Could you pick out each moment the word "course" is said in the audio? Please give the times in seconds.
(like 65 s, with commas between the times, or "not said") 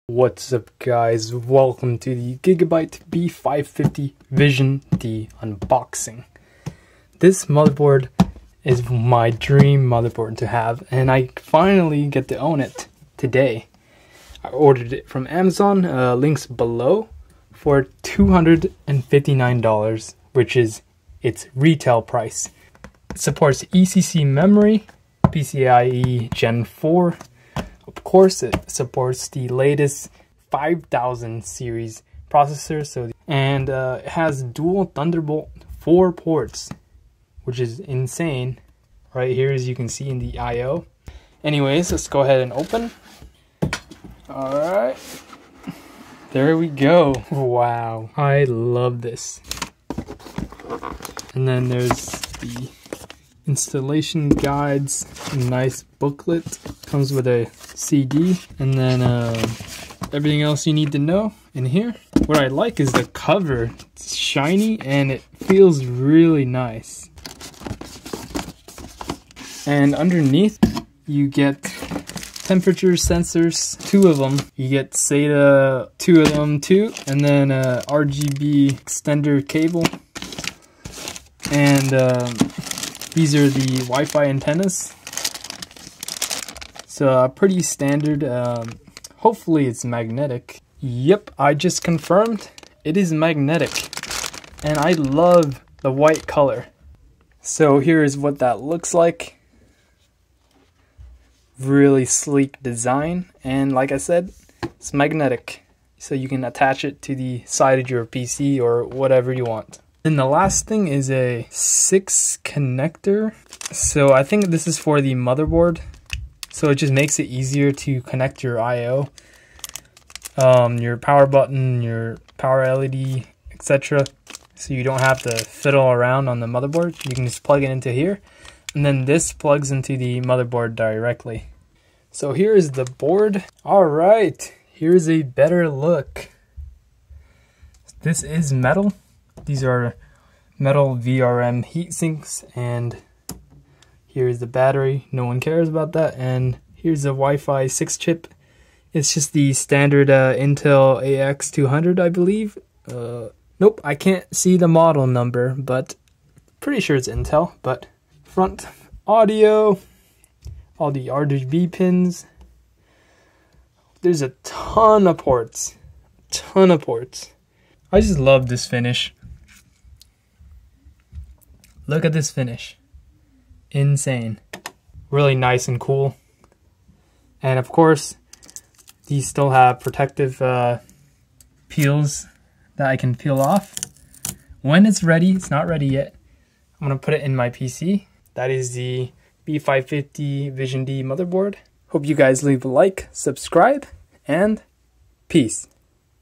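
28 s, 177 s.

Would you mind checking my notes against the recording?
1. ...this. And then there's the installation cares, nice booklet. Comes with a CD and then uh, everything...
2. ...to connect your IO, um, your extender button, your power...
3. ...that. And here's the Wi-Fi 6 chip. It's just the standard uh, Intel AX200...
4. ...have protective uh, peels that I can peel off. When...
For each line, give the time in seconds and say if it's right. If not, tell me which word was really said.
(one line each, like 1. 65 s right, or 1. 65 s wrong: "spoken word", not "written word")
1. 49 s wrong: "guides", not "cares"
2. 117 s wrong: "power", not "extender"
3. 145 s right
4. 179 s right.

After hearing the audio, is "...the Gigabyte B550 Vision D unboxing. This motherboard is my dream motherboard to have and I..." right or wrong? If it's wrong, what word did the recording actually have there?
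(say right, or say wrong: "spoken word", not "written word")
right.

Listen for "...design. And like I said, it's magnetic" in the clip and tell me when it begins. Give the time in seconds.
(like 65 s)
102 s.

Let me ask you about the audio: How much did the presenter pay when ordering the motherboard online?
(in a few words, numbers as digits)
$259.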